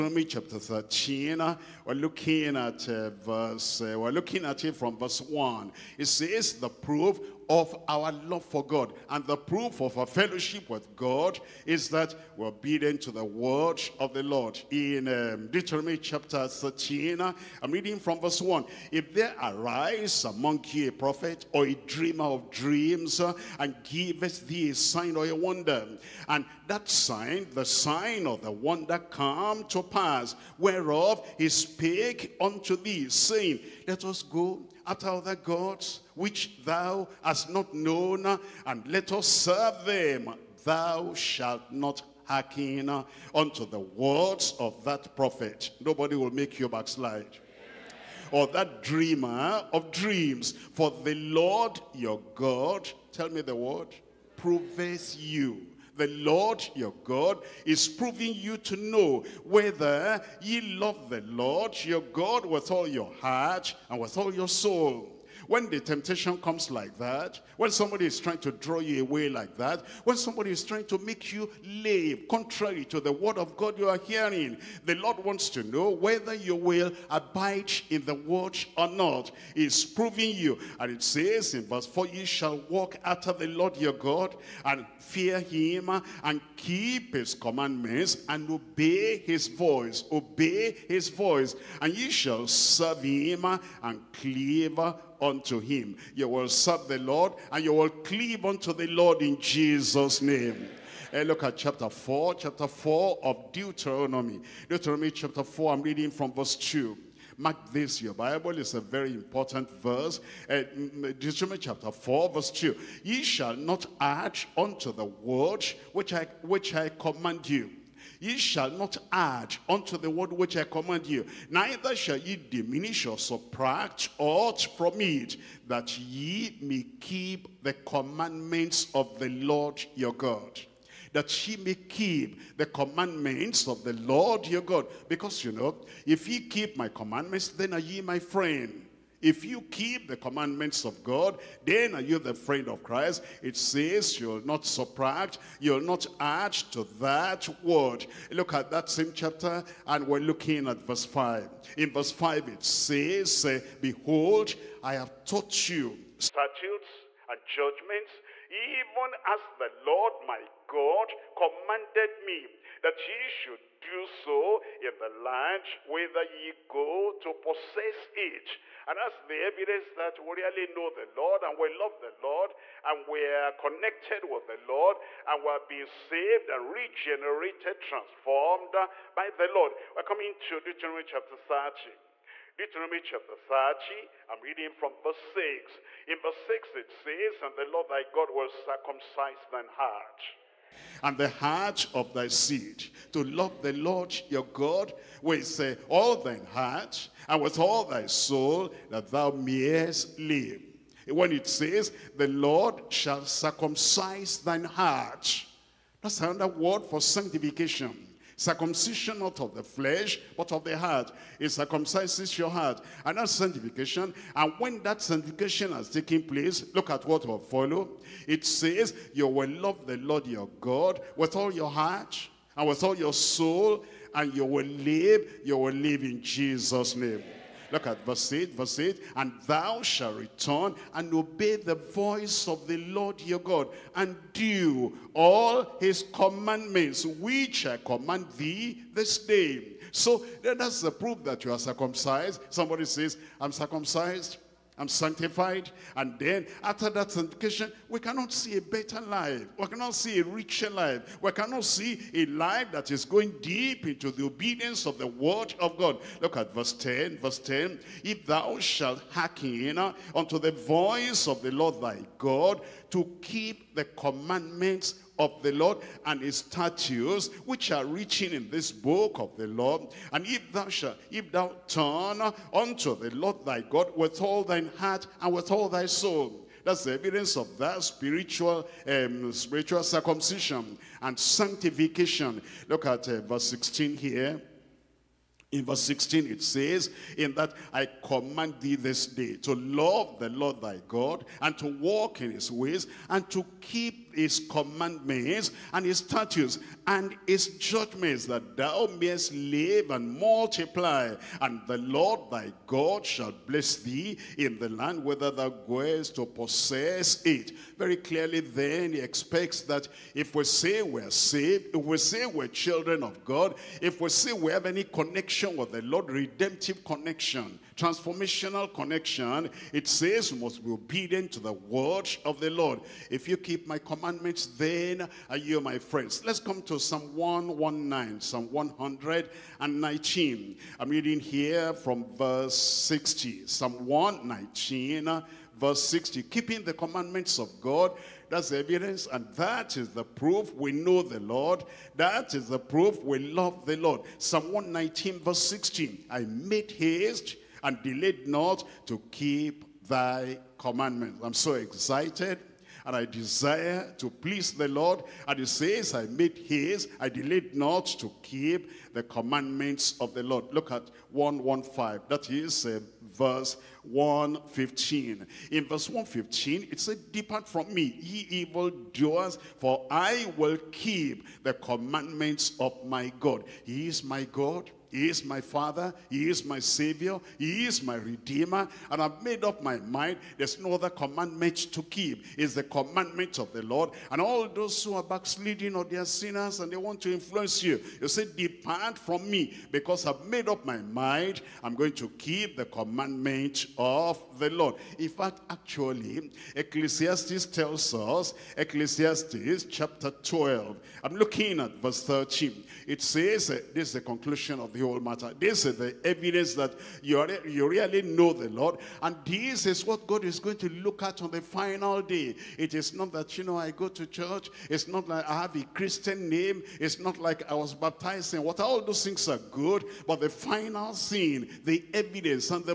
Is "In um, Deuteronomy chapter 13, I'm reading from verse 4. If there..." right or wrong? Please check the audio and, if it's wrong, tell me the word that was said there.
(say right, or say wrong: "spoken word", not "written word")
wrong: "1", not "4".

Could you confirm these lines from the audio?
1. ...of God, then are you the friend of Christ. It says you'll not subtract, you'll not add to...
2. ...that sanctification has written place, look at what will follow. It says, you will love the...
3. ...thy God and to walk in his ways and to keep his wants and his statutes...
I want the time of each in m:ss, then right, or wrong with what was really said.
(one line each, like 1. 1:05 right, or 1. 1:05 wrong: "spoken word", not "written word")
1. 2:20 right
2. 3:34 wrong: "taken", not "written"
3. 4:50 wrong: "commandments", not "wants".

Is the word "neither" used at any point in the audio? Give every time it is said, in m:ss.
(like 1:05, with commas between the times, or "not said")
2:01.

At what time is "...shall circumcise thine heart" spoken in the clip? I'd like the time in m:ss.
3:22.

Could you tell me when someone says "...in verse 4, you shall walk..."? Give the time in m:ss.
1:21.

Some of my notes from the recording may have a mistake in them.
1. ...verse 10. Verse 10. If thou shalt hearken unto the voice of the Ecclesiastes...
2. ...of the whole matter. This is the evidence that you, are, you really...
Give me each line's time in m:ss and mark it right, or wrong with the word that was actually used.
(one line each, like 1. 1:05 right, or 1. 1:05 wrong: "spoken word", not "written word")
1. 4:16 wrong: "Lord", not "Ecclesiastes"
2. 6:44 right.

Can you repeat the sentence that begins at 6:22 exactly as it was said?
It's the commandment of the Lord.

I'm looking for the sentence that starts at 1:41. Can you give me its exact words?
And eh, look at chapter 4, chapter 4 of Deuteronomy.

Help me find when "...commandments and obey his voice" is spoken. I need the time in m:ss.
1:27.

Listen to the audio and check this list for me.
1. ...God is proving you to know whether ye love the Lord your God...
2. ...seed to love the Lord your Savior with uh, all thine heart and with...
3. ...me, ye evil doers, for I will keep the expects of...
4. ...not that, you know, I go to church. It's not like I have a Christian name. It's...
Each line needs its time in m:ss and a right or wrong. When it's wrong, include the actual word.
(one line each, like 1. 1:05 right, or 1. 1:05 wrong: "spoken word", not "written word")
1. 0:57 right
2. 3:12 wrong: "God", not "Savior"
3. 6:07 wrong: "commandments", not "expects"
4. 6:52 right.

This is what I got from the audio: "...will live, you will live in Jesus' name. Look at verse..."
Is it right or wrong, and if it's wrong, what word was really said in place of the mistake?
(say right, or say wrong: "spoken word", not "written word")
right.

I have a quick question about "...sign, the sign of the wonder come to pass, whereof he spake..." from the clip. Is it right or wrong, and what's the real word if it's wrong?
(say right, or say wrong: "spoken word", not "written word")
right.